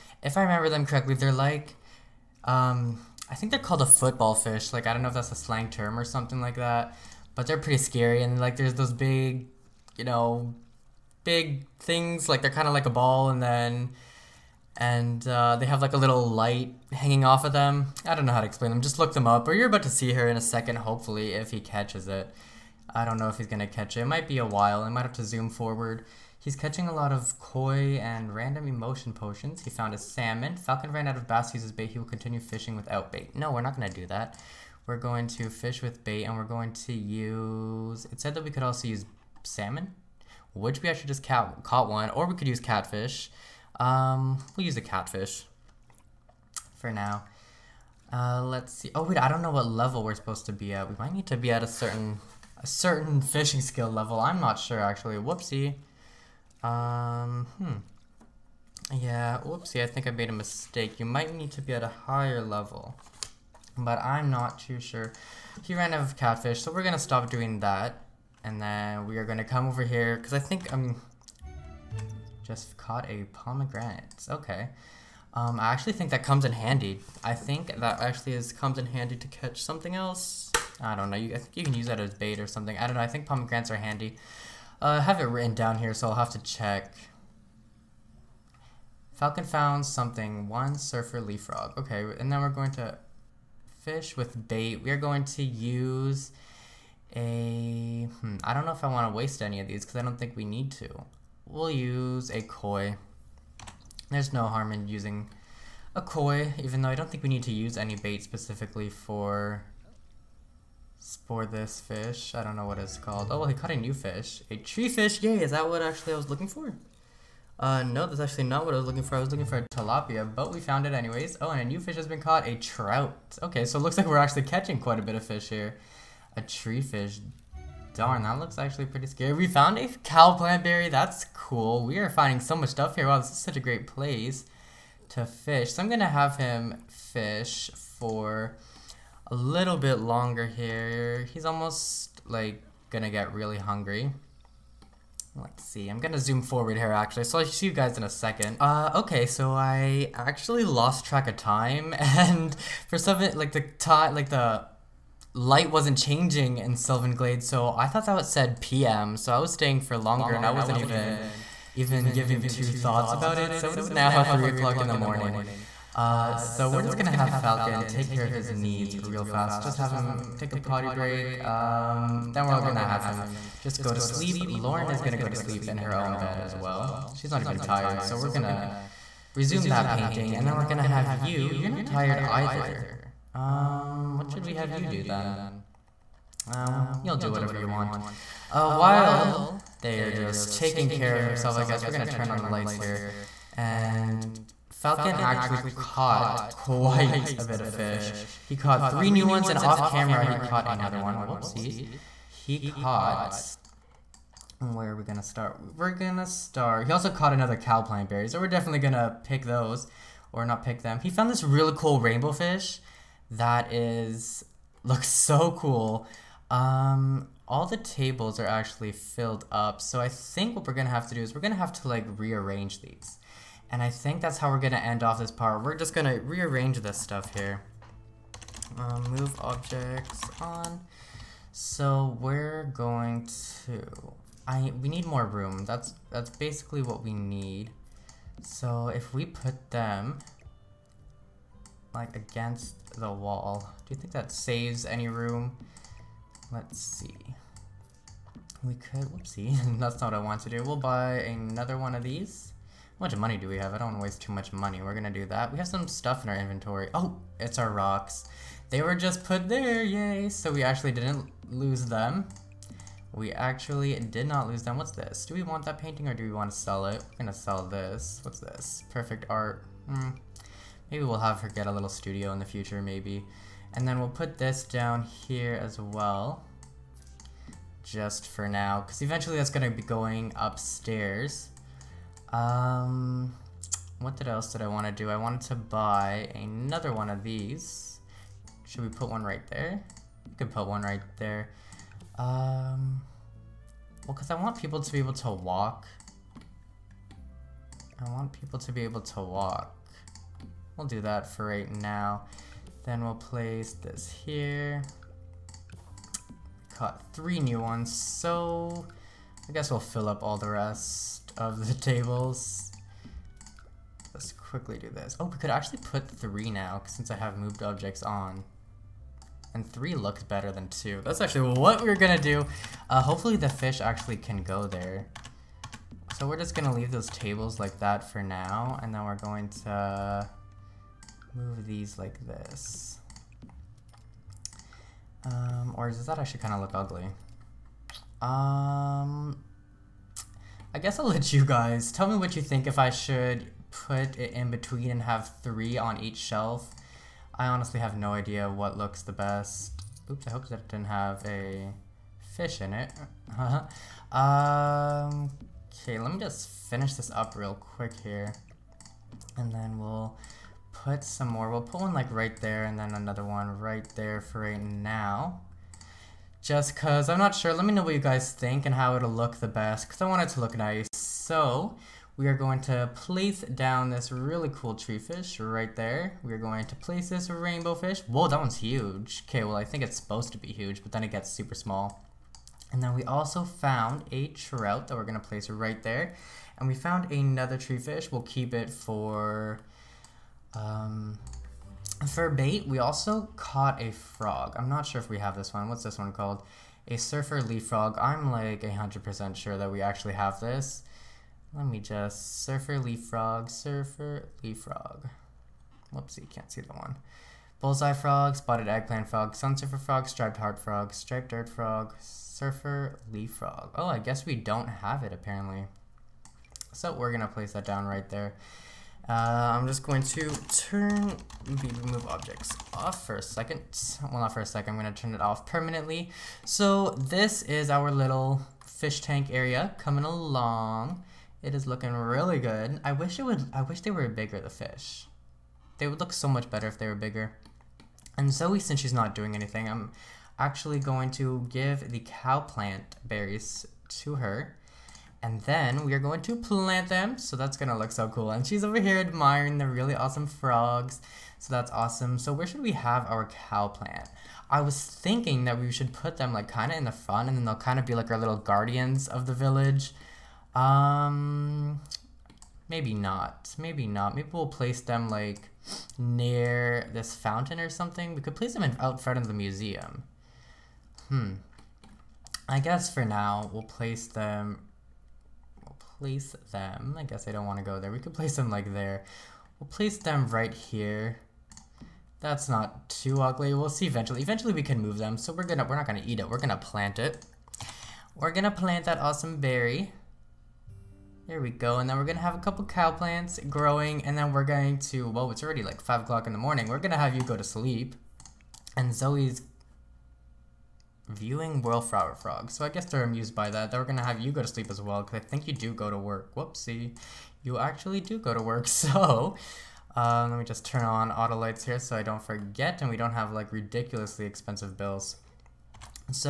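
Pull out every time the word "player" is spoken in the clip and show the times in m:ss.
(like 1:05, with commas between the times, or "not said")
not said.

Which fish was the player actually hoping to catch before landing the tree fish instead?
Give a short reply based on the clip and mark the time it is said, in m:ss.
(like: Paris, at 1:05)
tilapia, at 1:59.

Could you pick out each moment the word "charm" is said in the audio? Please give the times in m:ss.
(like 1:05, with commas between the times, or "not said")
not said.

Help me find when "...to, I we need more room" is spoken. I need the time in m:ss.
3:53.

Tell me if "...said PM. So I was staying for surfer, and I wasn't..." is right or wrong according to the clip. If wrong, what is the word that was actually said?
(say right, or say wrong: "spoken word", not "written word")
wrong: "longer", not "surfer".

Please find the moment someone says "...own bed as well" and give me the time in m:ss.
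2:55.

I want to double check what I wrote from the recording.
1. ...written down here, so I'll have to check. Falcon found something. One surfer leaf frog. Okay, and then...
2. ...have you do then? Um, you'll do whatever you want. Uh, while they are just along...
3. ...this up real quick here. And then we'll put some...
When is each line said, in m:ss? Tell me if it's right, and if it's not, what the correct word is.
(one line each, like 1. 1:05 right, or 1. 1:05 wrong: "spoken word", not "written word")
1. 1:25 right
2. 3:04 wrong: "taking", not "along"
3. 5:56 right.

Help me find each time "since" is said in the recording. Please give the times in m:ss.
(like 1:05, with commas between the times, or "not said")
5:16, 7:18.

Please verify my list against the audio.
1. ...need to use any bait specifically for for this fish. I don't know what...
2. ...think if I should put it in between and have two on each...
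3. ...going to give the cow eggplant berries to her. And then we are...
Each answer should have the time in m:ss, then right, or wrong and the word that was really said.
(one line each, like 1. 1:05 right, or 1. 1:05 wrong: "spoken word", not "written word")
1. 1:47 right
2. 5:42 wrong: "three", not "two"
3. 7:20 wrong: "plant", not "eggplant".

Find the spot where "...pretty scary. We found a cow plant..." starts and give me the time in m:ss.
2:08.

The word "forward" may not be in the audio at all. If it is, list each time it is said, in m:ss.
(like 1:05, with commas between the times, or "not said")
0:25, 2:26.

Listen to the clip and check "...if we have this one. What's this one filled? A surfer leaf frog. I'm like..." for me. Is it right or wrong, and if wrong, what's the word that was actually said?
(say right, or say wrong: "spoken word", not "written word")
wrong: "called", not "filled".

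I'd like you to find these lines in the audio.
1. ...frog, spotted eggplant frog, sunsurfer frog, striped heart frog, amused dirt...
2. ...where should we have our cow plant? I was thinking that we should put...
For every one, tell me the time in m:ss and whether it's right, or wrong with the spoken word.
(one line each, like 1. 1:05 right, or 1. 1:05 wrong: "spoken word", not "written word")
1. 6:47 wrong: "striped", not "amused"
2. 7:32 right.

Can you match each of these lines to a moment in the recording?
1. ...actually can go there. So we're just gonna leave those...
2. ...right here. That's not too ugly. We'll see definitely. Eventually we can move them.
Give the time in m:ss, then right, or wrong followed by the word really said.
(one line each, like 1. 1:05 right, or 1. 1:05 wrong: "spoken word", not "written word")
1. 5:23 right
2. 8:00 wrong: "eventually", not "definitely".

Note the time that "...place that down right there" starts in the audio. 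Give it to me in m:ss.
6:57.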